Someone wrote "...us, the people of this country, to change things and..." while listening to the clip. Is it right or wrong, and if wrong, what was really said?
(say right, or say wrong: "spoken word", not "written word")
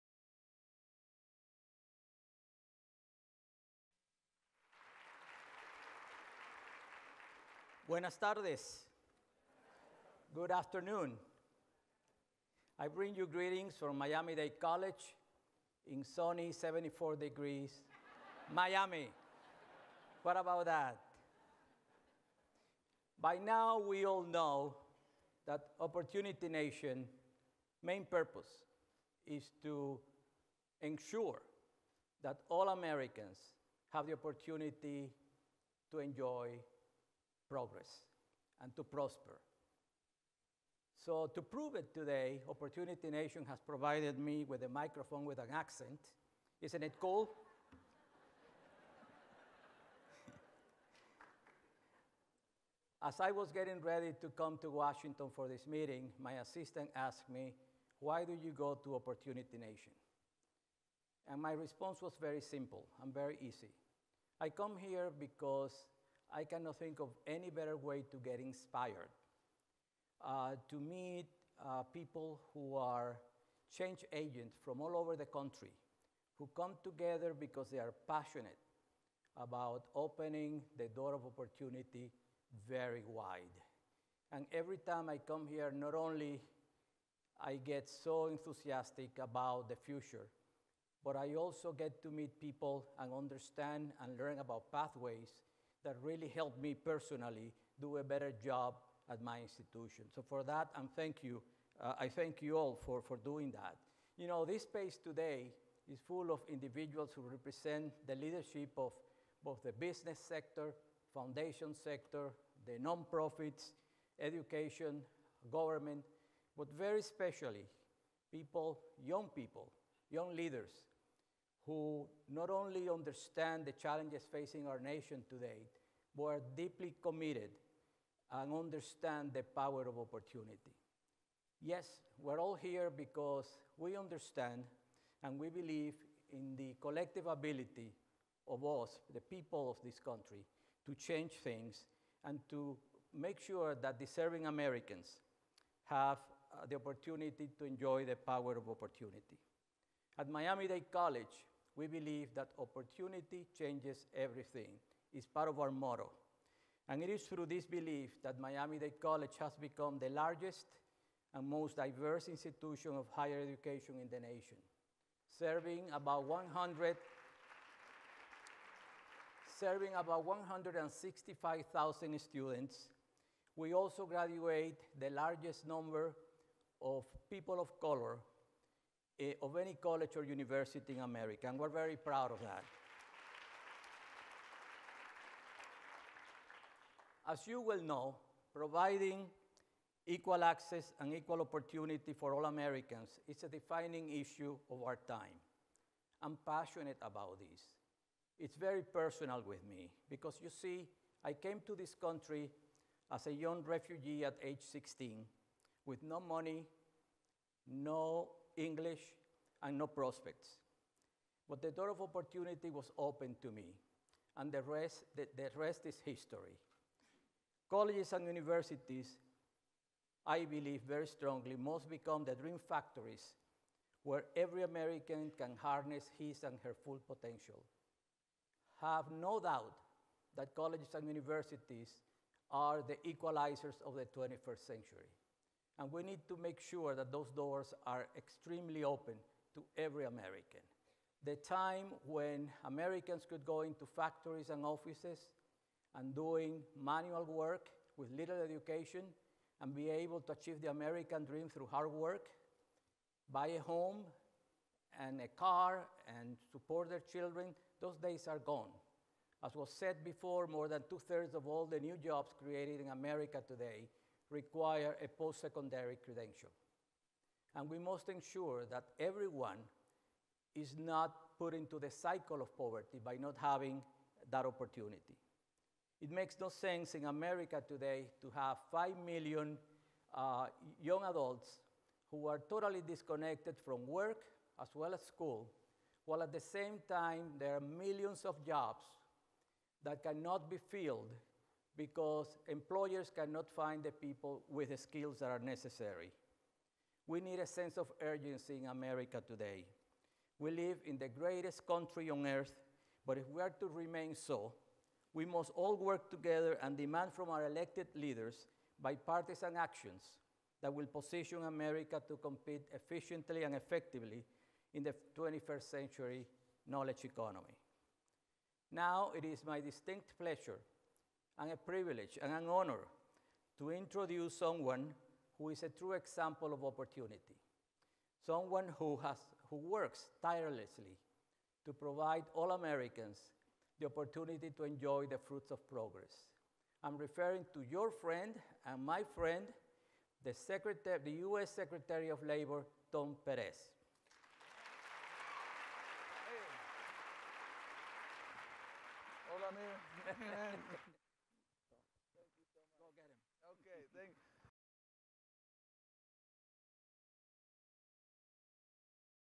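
right.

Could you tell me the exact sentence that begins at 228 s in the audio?
Have no doubt that colleges and universities are the equalizers of the 21st century.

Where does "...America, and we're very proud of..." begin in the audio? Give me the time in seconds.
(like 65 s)
180 s.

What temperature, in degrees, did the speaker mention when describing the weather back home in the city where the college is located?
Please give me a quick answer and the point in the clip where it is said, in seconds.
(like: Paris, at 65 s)
74, at 16 s.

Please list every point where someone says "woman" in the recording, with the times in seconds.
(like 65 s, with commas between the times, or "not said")
not said.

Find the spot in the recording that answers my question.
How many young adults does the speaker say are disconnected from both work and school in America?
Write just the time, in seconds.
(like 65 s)
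278 s.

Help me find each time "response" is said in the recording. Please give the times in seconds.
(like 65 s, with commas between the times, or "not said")
61 s.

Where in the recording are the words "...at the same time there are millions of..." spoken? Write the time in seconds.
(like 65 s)
286 s.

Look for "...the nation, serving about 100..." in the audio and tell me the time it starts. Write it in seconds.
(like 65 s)
164 s.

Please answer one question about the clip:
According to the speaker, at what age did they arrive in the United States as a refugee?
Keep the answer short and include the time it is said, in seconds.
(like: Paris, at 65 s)
16, at 204 s.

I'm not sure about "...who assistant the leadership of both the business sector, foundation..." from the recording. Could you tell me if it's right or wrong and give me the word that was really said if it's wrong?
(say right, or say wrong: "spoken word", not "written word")
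wrong: "represent", not "assistant".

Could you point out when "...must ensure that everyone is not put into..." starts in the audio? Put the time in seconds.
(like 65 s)
267 s.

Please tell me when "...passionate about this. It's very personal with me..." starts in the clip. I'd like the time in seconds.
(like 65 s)
196 s.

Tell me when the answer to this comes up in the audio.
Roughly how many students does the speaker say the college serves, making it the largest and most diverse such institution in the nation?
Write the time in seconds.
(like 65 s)
170 s.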